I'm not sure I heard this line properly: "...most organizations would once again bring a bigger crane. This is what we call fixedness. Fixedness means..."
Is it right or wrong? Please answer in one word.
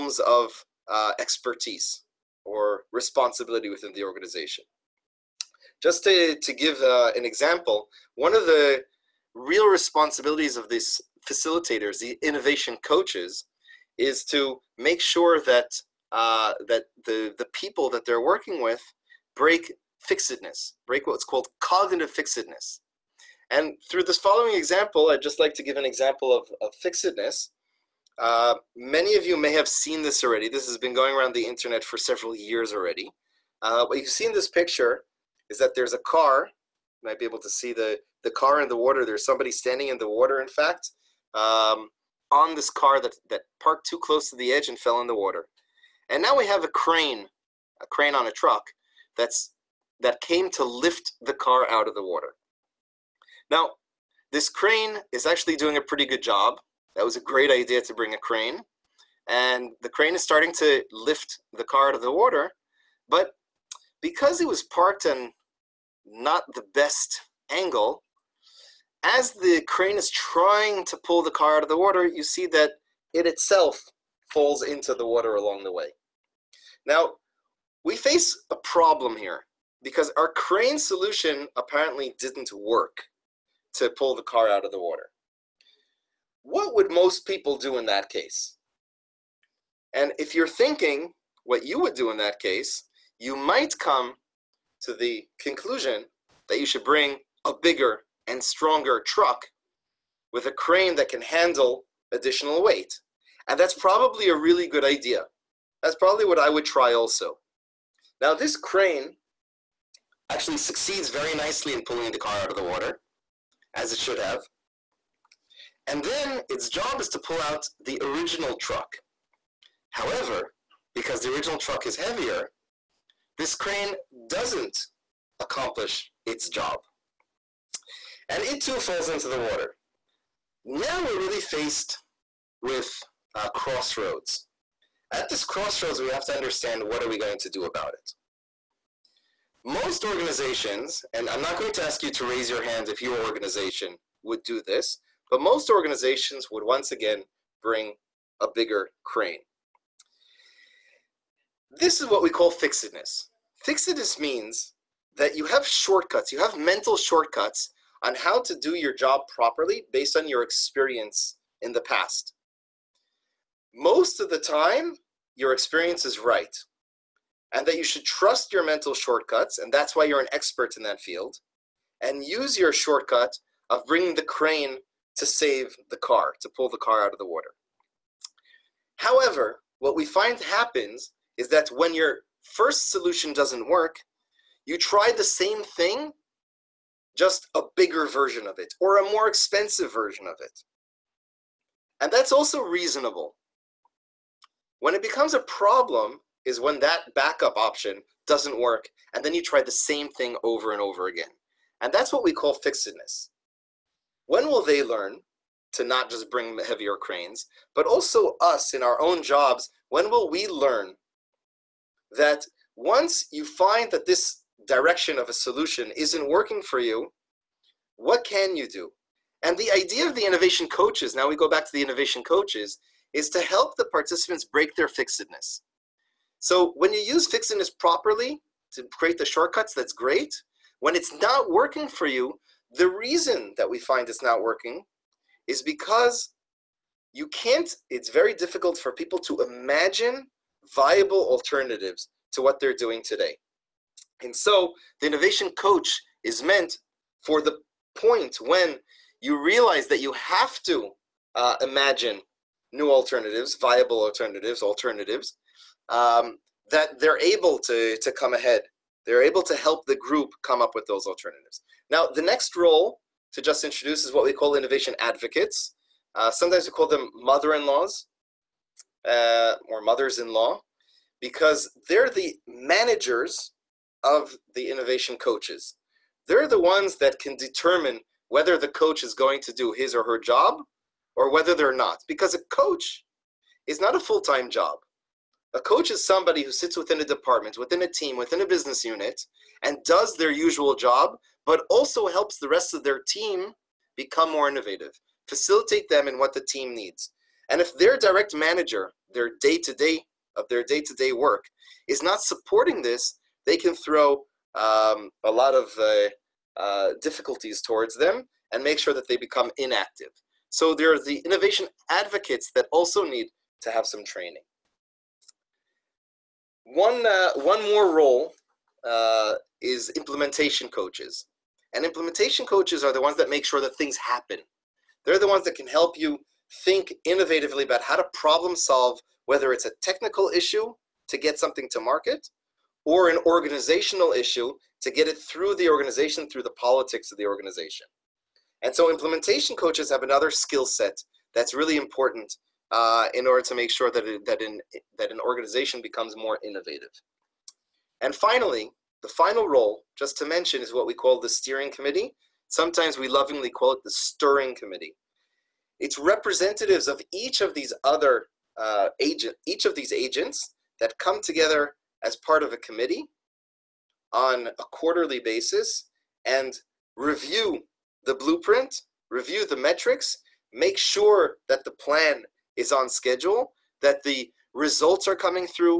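right.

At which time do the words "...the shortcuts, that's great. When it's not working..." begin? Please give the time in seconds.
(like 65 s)
229 s.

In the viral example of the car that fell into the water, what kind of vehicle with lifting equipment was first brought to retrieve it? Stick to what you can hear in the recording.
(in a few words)
a crane on a truck.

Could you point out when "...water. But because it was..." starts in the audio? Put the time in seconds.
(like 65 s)
62 s.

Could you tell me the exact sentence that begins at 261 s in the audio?
Now, the next role to just introduce is what we call innovation advocates.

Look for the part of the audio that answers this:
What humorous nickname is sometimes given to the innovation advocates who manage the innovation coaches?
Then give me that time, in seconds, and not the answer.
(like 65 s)
269 s.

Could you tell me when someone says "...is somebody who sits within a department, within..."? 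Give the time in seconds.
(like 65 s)
285 s.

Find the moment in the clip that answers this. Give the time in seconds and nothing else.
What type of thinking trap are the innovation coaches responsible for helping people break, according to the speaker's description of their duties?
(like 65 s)
21 s.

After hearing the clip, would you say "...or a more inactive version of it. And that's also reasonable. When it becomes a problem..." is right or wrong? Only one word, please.
wrong.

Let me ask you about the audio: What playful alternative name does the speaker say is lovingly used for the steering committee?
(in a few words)
stirring committee.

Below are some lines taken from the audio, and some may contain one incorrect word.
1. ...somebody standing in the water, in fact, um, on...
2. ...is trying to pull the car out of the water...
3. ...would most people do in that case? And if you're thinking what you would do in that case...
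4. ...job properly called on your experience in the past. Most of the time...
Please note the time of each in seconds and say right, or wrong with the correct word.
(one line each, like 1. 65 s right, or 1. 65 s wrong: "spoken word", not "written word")
1. 39 s right
2. 69 s right
3. 86 s right
4. 158 s wrong: "based", not "called".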